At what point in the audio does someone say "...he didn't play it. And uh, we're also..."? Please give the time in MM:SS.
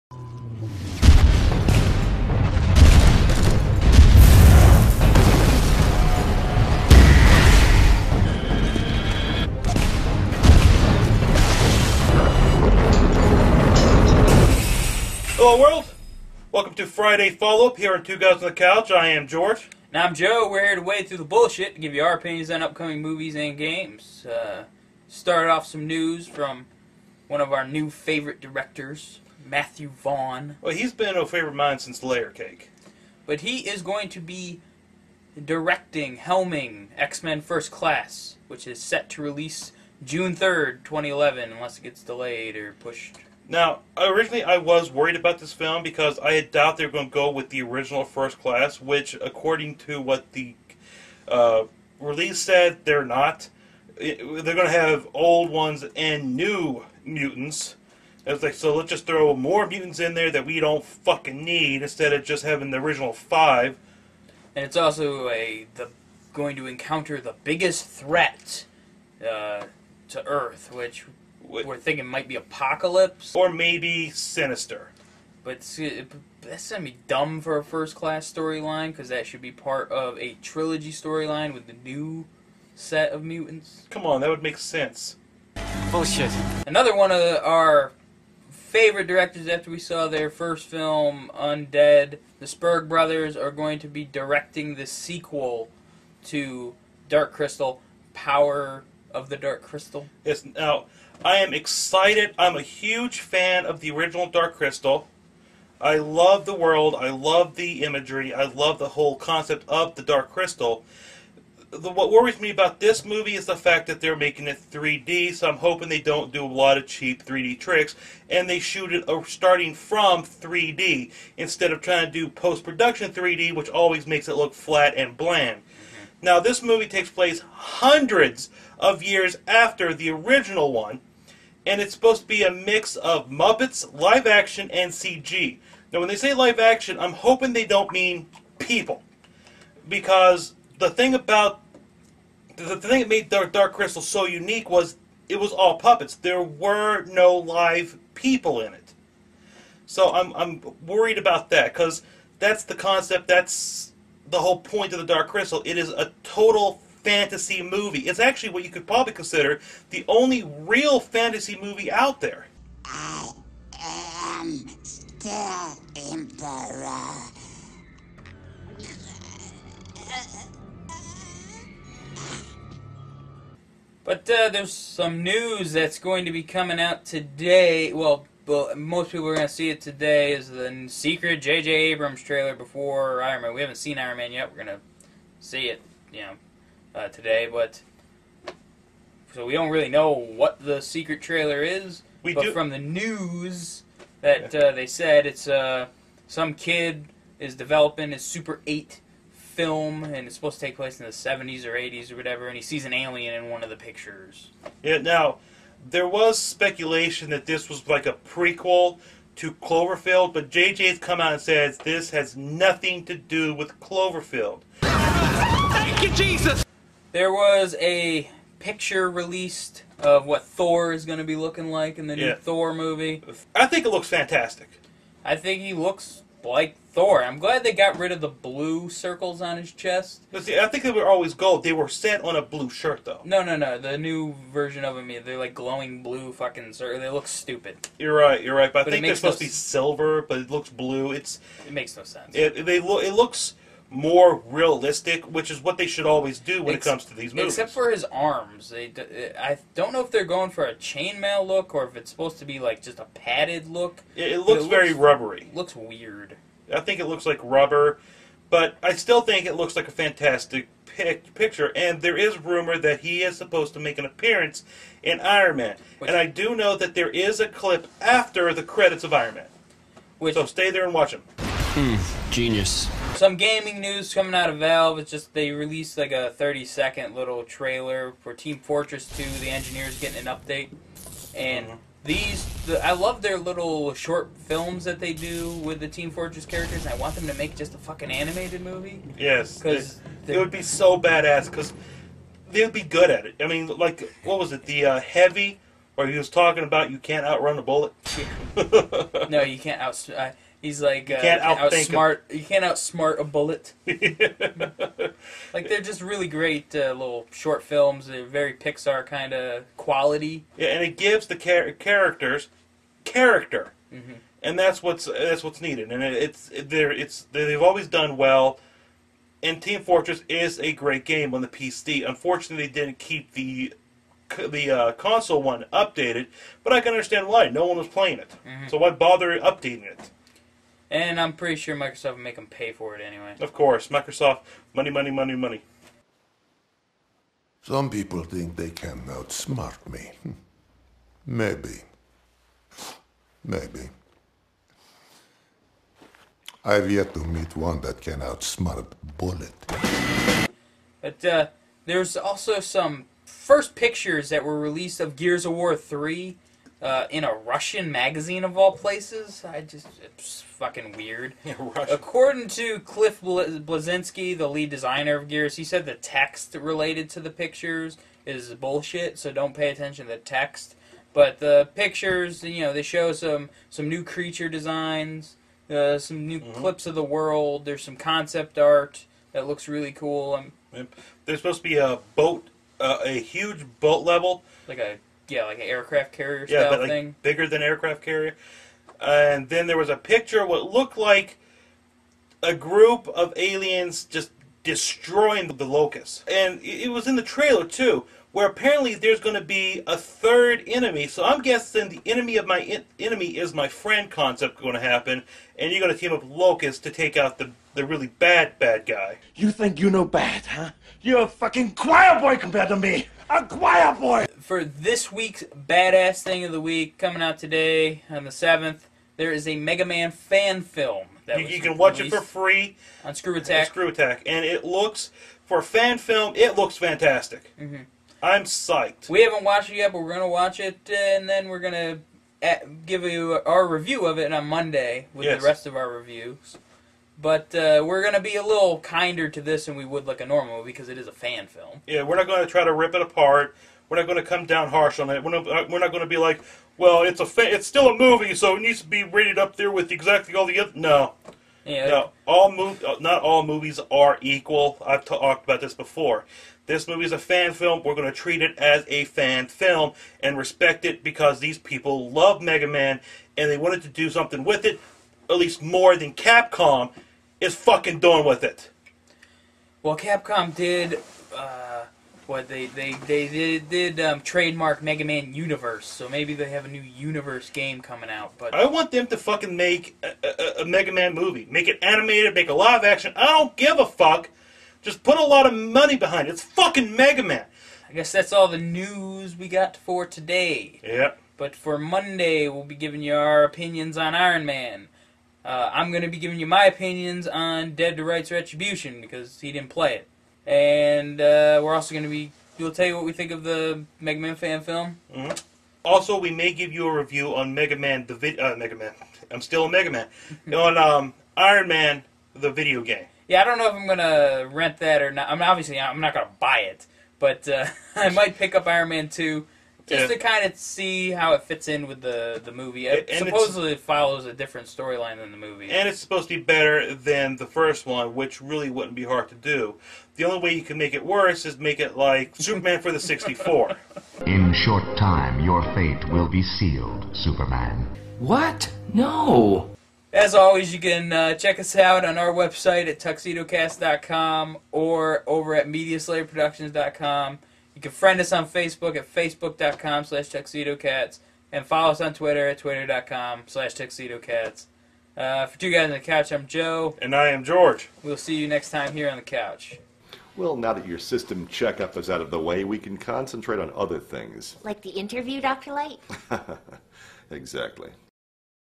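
08:19.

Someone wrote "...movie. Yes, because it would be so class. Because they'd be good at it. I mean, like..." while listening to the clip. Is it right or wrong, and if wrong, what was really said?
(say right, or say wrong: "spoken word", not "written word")
wrong: "badass", not "class".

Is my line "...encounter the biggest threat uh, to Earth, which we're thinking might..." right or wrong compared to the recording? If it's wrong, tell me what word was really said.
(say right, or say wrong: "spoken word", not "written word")
right.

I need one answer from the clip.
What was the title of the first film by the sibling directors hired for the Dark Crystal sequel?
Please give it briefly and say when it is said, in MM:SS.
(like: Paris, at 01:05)
Undead, at 01:31.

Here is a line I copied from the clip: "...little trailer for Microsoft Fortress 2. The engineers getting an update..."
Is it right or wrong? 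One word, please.
wrong.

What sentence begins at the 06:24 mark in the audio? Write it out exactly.
Like a yeah, like an aircraft carrier yeah, but like thing.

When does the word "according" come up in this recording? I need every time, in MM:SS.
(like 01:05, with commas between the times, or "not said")
00:49, 06:01.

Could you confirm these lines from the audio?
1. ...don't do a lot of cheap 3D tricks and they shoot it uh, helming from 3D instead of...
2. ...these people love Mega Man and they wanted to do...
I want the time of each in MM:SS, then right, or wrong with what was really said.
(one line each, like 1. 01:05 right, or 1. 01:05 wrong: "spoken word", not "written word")
1. 01:56 wrong: "starting", not "helming"
2. 07:41 right.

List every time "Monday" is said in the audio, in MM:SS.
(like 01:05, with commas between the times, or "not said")
07:14, 08:11.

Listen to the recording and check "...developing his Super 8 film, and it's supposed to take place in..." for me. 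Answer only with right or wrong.
right.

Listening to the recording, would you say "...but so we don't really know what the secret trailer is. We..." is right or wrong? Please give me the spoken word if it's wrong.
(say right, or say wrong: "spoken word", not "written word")
right.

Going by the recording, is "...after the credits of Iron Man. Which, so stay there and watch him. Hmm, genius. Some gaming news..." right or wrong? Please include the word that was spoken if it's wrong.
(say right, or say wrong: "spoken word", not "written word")
right.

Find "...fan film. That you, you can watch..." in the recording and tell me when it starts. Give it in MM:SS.
07:00.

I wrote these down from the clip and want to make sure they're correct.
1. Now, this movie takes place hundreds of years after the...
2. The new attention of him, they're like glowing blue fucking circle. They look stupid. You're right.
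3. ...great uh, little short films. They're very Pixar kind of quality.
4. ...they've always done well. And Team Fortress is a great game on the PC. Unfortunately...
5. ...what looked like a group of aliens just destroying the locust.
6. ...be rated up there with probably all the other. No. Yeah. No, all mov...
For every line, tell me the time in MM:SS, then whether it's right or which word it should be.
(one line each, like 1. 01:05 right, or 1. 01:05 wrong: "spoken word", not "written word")
1. 02:06 right
2. 03:53 wrong: "version", not "attention"
3. 05:06 right
4. 05:17 right
5. 06:30 right
6. 07:28 wrong: "exactly", not "probably".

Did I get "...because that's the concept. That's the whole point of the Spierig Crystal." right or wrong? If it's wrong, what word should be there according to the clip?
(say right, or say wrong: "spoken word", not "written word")
wrong: "Dark", not "Spierig".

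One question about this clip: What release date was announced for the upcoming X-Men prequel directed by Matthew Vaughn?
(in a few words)
June 3rd, 2011.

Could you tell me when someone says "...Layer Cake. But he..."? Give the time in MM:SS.
00:32.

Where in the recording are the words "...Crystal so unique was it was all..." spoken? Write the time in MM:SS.
02:23.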